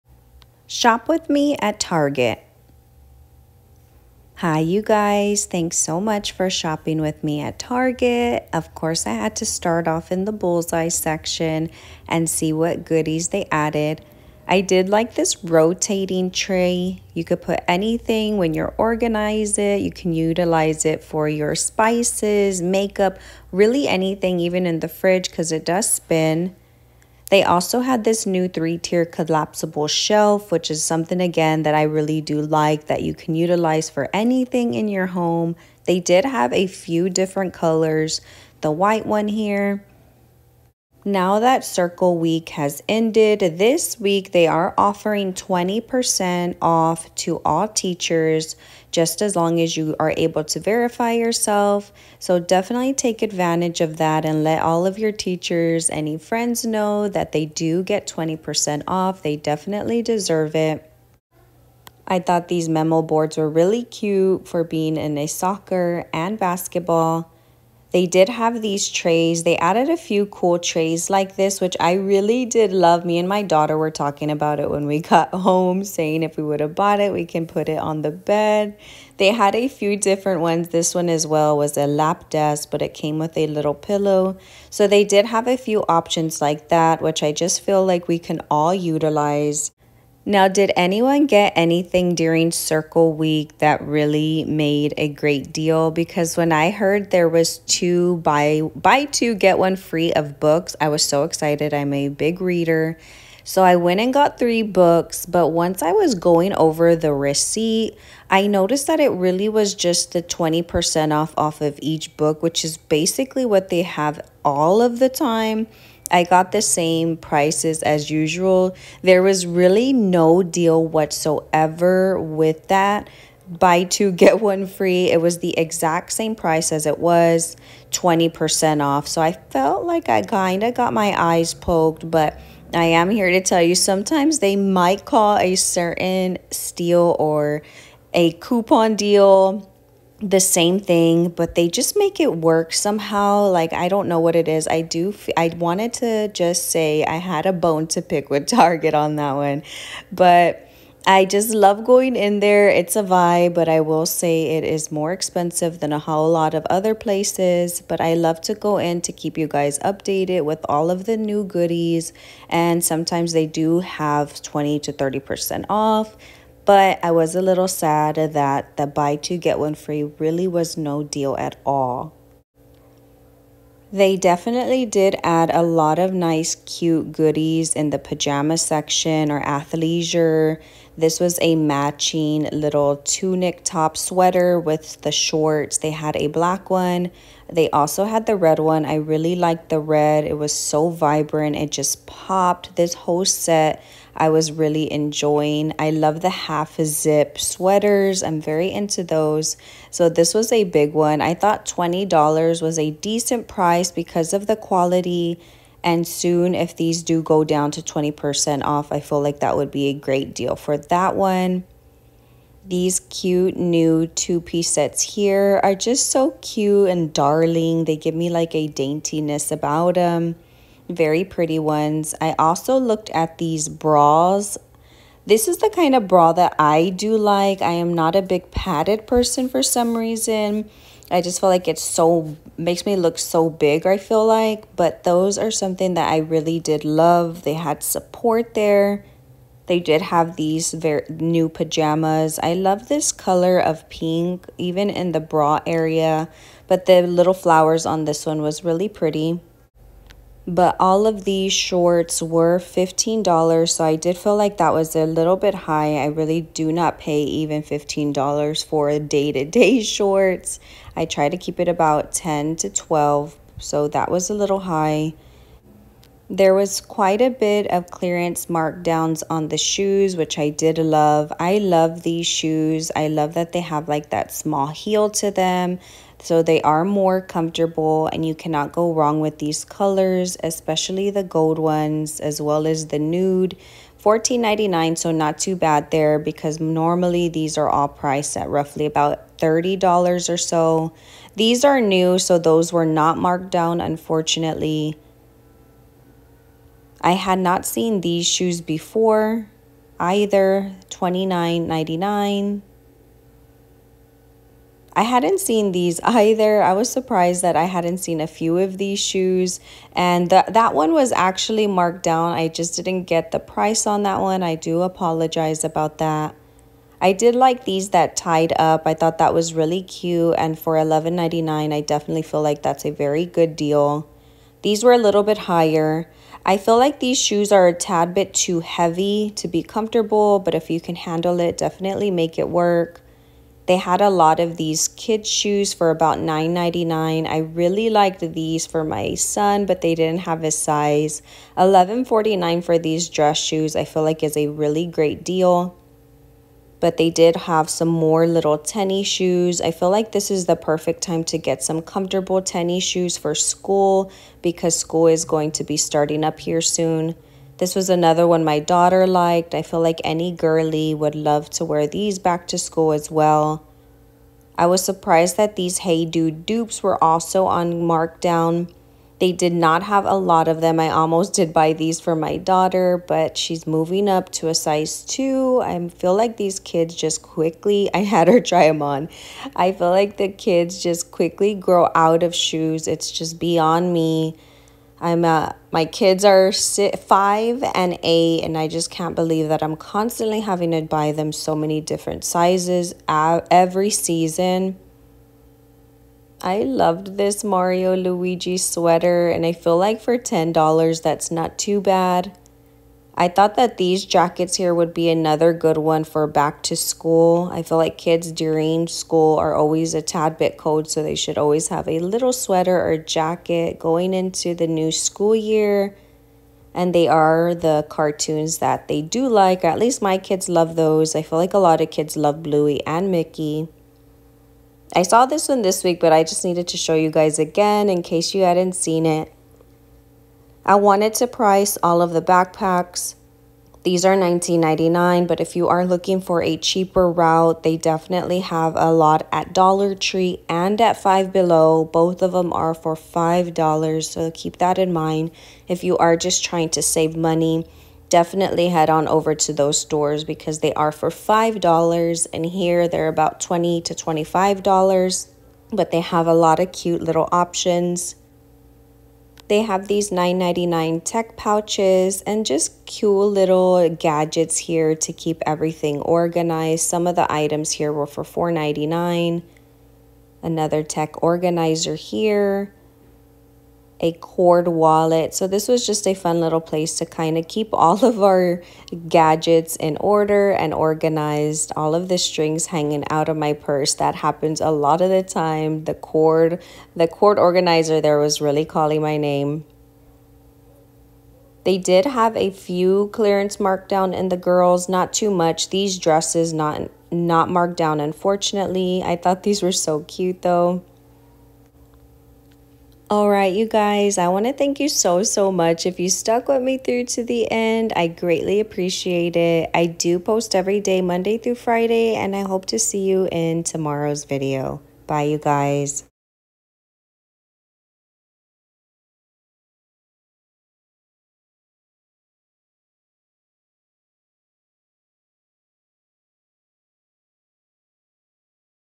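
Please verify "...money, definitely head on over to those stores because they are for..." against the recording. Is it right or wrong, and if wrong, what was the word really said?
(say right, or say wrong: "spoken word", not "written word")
right.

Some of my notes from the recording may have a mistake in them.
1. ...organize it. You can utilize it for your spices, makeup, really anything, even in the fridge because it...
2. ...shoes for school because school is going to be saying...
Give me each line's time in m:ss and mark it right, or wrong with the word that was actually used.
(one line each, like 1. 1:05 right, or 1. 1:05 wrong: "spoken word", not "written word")
1. 0:18 right
2. 5:52 wrong: "starting", not "saying".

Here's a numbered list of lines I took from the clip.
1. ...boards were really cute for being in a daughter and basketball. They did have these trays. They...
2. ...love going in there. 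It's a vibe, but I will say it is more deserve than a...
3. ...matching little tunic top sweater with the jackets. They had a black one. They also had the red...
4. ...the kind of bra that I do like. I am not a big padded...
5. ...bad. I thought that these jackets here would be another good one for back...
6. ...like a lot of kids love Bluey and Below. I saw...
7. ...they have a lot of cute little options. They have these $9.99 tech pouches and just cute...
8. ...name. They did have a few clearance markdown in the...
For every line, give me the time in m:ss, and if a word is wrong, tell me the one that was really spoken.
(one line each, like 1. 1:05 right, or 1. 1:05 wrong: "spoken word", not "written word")
1. 1:03 wrong: "soccer", not "daughter"
2. 2:31 wrong: "expensive", not "deserve"
3. 3:01 wrong: "shorts", not "jackets"
4. 3:45 right
5. 6:41 right
6. 7:01 wrong: "Mickey", not "Below"
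7. 7:35 right
8. 8:09 right.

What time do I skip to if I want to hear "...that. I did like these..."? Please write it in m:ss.
5:15.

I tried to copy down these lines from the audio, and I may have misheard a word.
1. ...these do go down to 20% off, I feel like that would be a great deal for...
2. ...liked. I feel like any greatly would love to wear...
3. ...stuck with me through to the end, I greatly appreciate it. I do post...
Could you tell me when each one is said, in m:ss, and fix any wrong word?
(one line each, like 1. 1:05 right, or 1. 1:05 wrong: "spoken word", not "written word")
1. 3:26 right
2. 5:59 wrong: "girly", not "greatly"
3. 8:26 right.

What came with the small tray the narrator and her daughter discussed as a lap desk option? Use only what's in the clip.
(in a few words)
a little pillow.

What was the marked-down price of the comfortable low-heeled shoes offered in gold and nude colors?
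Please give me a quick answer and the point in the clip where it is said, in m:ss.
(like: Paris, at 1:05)
$14.99, at 4:43.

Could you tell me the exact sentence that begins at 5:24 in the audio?
These were a little bit higher.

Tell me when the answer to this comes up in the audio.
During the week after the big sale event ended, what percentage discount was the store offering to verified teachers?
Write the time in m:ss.
0:45.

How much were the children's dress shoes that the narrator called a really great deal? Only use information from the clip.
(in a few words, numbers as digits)
$11.49.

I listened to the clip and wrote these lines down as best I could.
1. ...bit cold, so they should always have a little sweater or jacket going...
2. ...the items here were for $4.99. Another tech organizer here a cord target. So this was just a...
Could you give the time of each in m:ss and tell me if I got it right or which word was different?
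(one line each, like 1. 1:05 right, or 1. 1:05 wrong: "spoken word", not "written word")
1. 6:50 right
2. 7:47 wrong: "wallet", not "target".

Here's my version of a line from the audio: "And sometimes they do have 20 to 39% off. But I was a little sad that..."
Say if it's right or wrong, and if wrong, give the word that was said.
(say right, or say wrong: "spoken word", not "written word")
wrong: "30", not "39".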